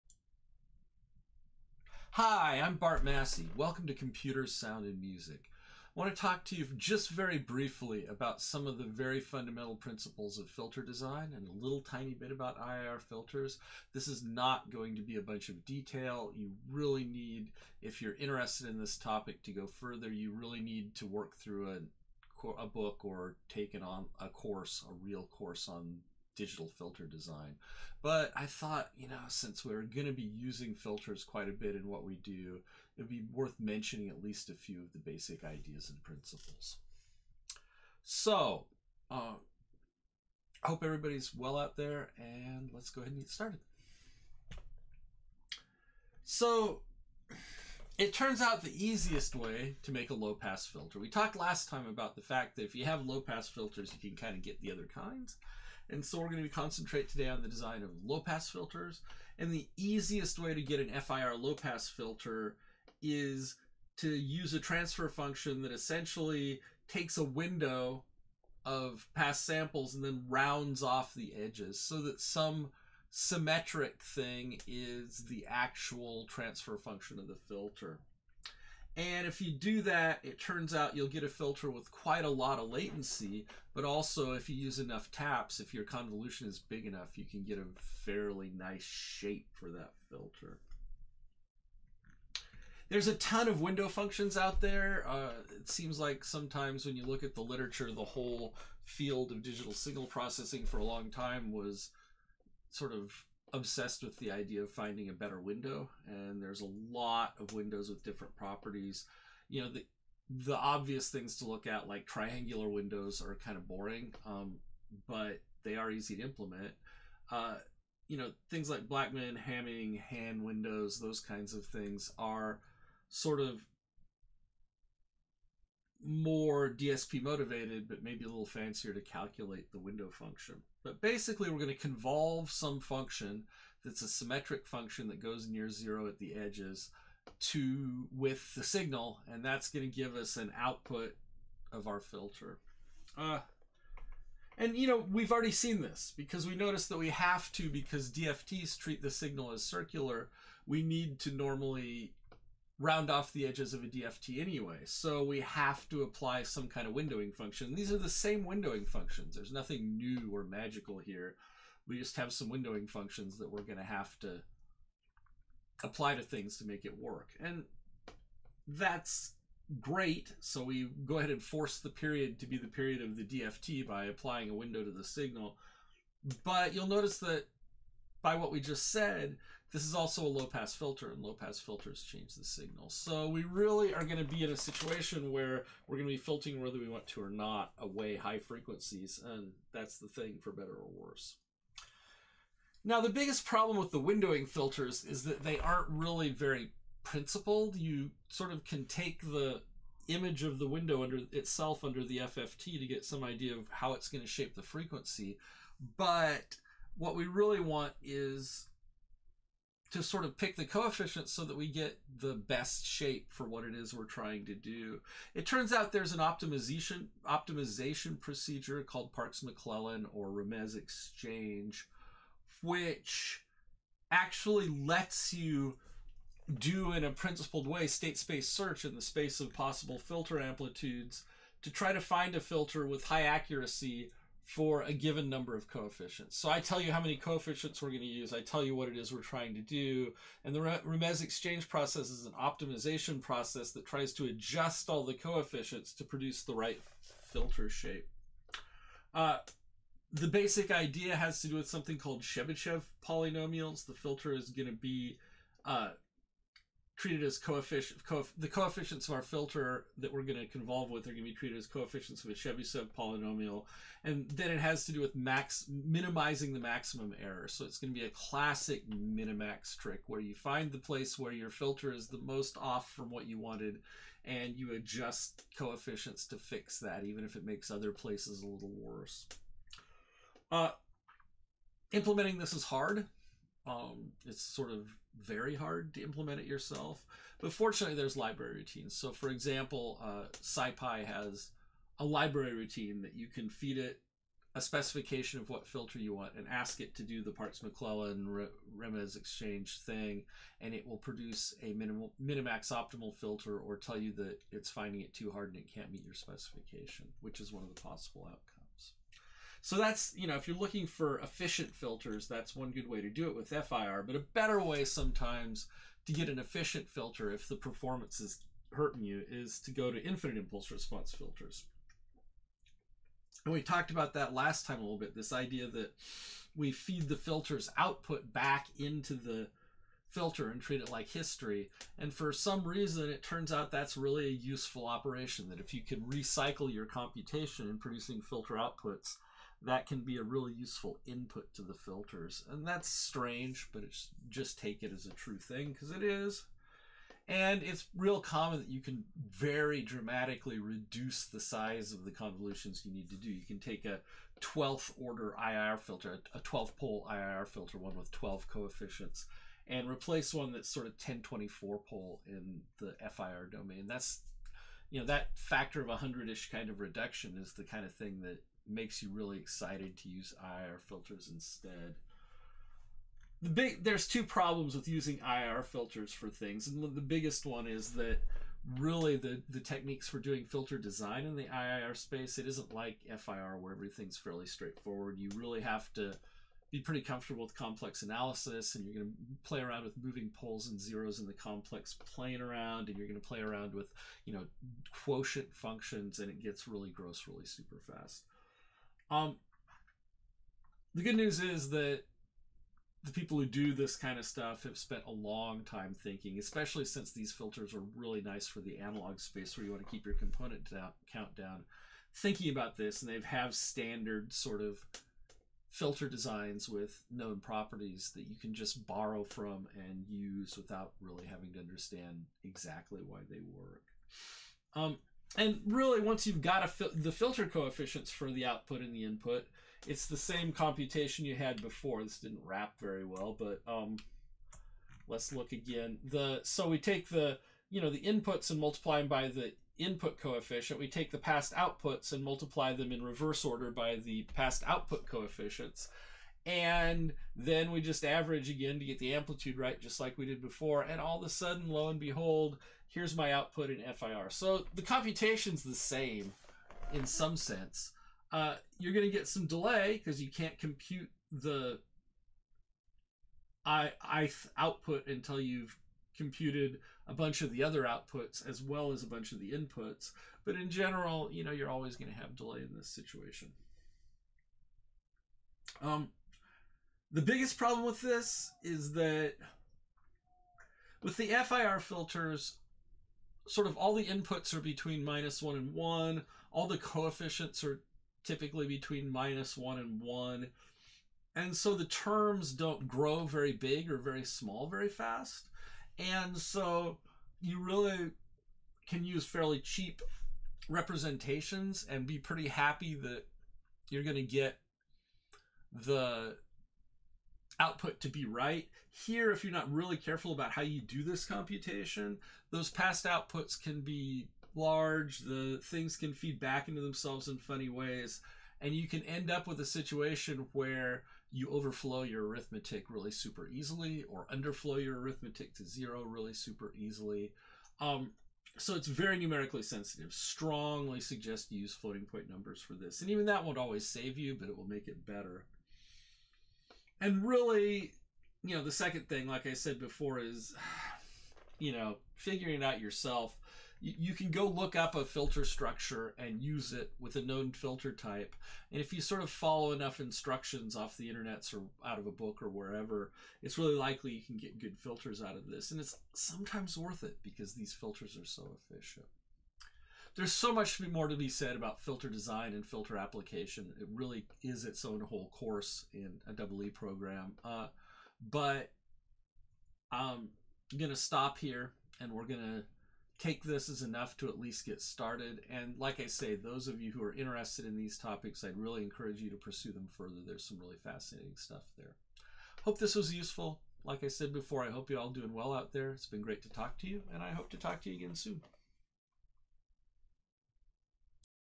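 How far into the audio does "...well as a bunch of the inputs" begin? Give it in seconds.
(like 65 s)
468 s.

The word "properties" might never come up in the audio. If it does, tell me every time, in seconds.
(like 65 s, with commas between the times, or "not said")
108 s, 417 s.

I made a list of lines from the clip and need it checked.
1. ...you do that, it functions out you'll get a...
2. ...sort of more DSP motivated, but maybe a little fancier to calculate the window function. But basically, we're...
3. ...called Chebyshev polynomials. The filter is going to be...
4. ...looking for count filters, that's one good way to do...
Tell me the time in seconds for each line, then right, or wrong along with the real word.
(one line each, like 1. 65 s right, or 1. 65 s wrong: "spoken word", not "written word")
1. 79 s wrong: "turns", not "functions"
2. 123 s right
3. 251 s right
4. 310 s wrong: "efficient", not "count".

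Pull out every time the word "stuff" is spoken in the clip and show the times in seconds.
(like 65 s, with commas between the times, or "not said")
404 s, 581 s.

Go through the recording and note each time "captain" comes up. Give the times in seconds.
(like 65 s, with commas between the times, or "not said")
not said.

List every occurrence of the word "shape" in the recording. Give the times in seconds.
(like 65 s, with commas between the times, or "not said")
88 s, 204 s, 212 s, 247 s.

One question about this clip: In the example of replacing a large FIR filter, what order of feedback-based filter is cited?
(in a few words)
12th order.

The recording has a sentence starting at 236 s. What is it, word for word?
So I tell you how many coefficients we're going to use.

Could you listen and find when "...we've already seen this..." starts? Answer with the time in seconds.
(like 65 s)
145 s.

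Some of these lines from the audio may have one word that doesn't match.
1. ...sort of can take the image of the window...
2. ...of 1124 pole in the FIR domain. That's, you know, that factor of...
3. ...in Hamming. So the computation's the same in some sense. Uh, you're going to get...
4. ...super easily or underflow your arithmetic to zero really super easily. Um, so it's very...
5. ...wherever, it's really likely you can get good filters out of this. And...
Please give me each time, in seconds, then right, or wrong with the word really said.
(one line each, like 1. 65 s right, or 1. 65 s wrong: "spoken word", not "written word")
1. 198 s right
2. 360 s wrong: "1024", not "1124"
3. 453 s wrong: "FIR", not "Hamming"
4. 523 s right
5. 552 s right.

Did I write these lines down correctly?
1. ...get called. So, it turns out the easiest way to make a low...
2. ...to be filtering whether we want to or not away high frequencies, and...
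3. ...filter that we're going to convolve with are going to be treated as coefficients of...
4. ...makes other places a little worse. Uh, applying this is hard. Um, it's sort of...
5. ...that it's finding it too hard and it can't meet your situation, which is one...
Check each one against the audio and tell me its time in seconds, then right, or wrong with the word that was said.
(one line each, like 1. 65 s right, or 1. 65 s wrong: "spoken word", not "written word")
1. 43 s wrong: "started", not "called"
2. 186 s right
3. 259 s right
4. 277 s wrong: "implementing", not "applying"
5. 304 s wrong: "specification", not "situation".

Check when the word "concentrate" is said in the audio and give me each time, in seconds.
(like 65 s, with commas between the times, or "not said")
56 s.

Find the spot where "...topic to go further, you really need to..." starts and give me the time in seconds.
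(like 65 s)
18 s.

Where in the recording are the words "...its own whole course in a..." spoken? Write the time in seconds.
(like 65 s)
564 s.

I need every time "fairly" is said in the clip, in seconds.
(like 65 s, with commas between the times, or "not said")
88 s, 384 s, 499 s.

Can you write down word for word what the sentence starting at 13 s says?
This is not going to be a bunch of detail.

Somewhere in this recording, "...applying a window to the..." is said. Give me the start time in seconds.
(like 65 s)
174 s.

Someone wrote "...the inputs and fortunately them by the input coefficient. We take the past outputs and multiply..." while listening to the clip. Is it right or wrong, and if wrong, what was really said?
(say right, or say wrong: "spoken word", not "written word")
wrong: "multiply", not "fortunately".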